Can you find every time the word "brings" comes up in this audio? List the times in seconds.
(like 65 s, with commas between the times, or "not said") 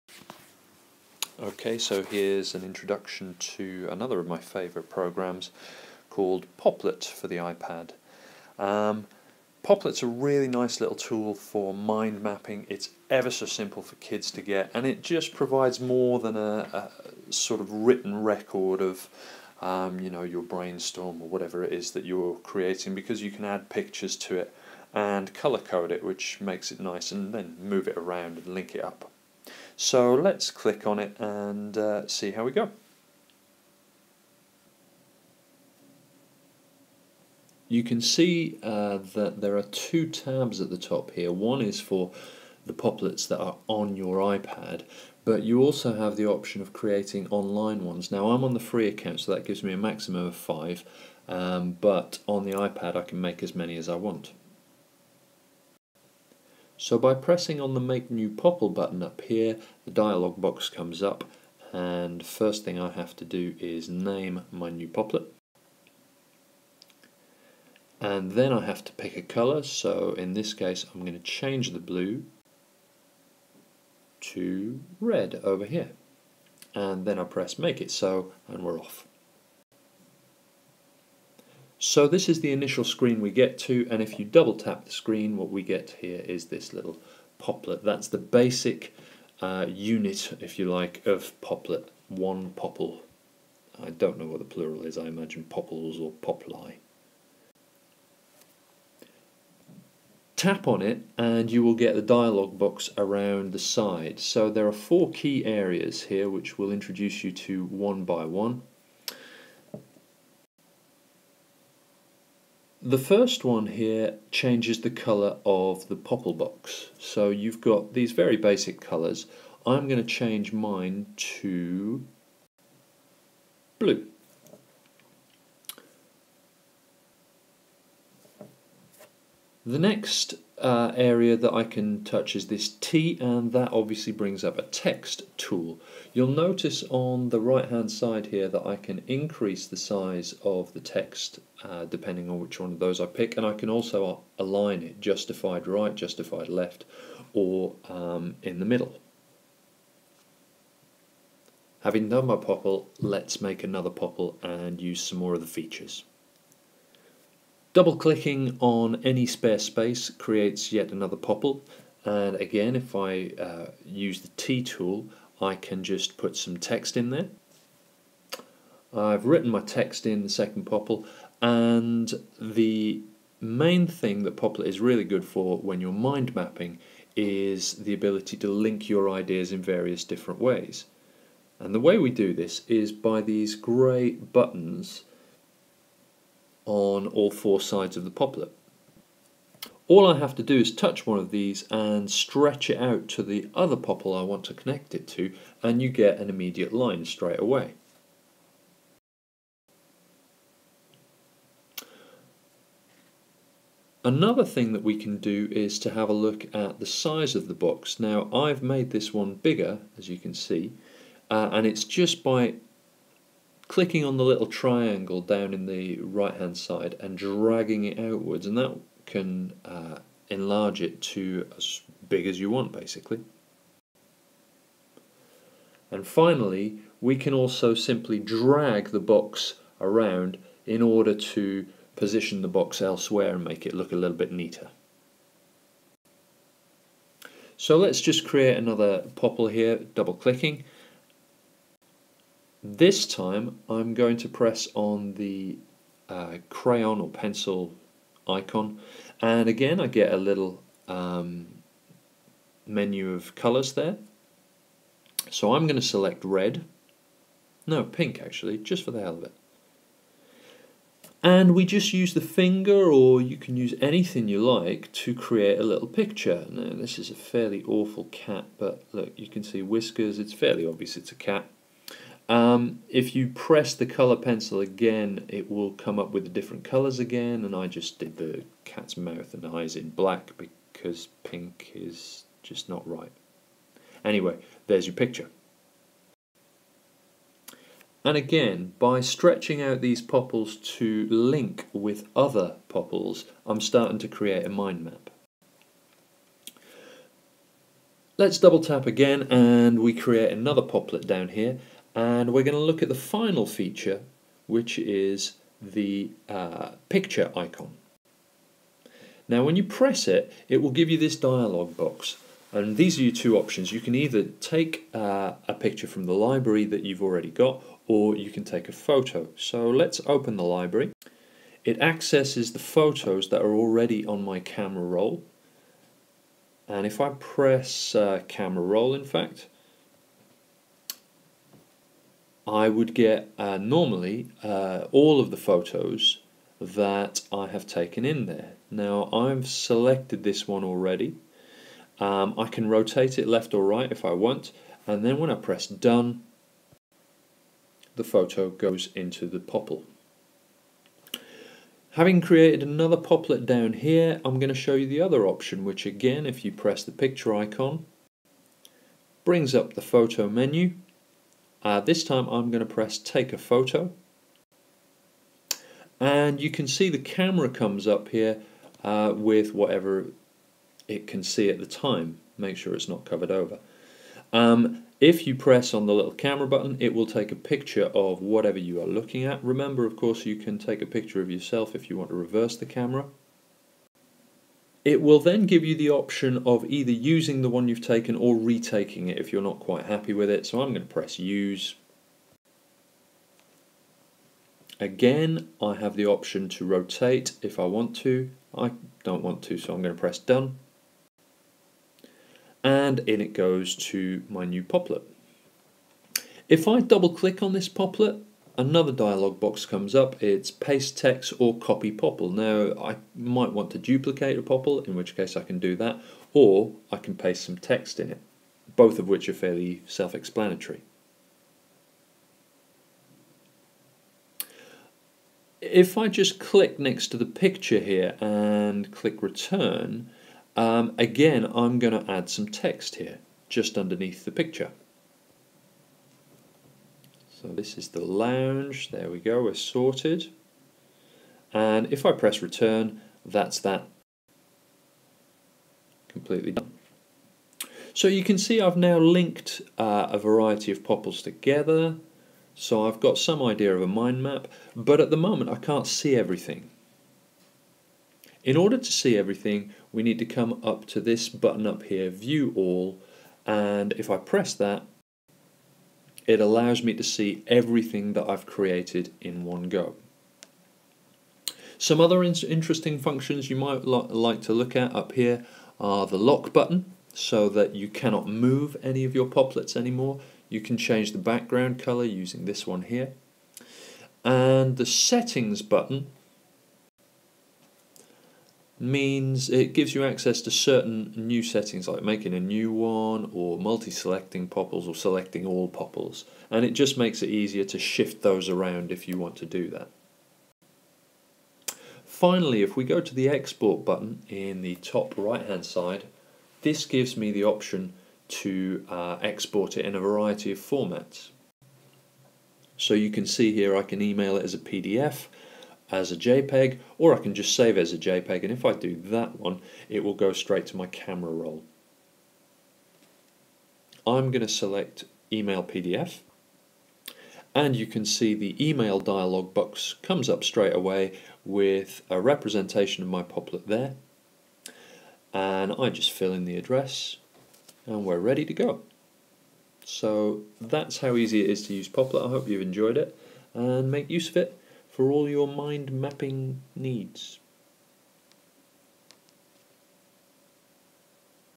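134 s, 359 s.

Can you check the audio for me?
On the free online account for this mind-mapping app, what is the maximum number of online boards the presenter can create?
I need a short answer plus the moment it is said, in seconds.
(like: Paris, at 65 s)
5, at 50 s.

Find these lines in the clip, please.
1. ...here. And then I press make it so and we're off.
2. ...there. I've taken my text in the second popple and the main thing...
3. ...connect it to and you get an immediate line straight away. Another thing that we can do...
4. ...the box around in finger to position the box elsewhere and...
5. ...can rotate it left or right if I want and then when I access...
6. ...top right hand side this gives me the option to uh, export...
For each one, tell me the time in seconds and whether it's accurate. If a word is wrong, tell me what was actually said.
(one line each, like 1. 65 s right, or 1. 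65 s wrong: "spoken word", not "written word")
1. 75 s right
2. 167 s wrong: "written", not "taken"
3. 194 s right
4. 228 s wrong: "order", not "finger"
5. 342 s wrong: "press", not "access"
6. 504 s right.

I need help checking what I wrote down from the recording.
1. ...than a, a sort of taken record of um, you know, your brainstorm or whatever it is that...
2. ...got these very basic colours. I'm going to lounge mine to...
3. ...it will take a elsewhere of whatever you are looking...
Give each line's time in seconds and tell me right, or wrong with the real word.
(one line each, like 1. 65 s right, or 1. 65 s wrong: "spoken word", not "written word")
1. 16 s wrong: "written", not "taken"
2. 117 s wrong: "change", not "lounge"
3. 376 s wrong: "picture", not "elsewhere".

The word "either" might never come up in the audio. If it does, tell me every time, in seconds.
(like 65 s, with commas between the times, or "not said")
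313 s, 386 s.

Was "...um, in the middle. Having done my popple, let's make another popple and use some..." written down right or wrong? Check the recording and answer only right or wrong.
right.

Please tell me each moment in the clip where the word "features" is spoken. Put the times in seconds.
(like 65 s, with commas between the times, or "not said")
155 s, 303 s.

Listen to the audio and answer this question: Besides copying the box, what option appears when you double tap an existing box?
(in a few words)
Paste text.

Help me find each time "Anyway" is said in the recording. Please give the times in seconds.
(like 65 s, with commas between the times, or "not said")
284 s.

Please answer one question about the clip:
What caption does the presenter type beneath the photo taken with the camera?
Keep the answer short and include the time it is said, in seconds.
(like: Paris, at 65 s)
The lounge, at 437 s.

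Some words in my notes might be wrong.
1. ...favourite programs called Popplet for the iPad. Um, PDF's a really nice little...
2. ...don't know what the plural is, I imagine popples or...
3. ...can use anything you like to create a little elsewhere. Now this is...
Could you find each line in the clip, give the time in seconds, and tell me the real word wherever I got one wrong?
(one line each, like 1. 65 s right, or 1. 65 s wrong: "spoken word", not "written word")
1. 4 s wrong: "Popplet", not "PDF"
2. 93 s right
3. 263 s wrong: "picture", not "elsewhere".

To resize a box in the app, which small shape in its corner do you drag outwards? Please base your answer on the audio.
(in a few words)
Triangle.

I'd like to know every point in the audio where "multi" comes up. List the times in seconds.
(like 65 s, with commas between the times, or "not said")
493 s.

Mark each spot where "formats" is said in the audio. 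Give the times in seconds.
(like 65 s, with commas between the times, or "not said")
510 s.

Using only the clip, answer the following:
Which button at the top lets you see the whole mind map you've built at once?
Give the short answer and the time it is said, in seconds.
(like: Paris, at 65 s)
View All, at 462 s.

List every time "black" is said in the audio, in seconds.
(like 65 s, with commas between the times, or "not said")
279 s.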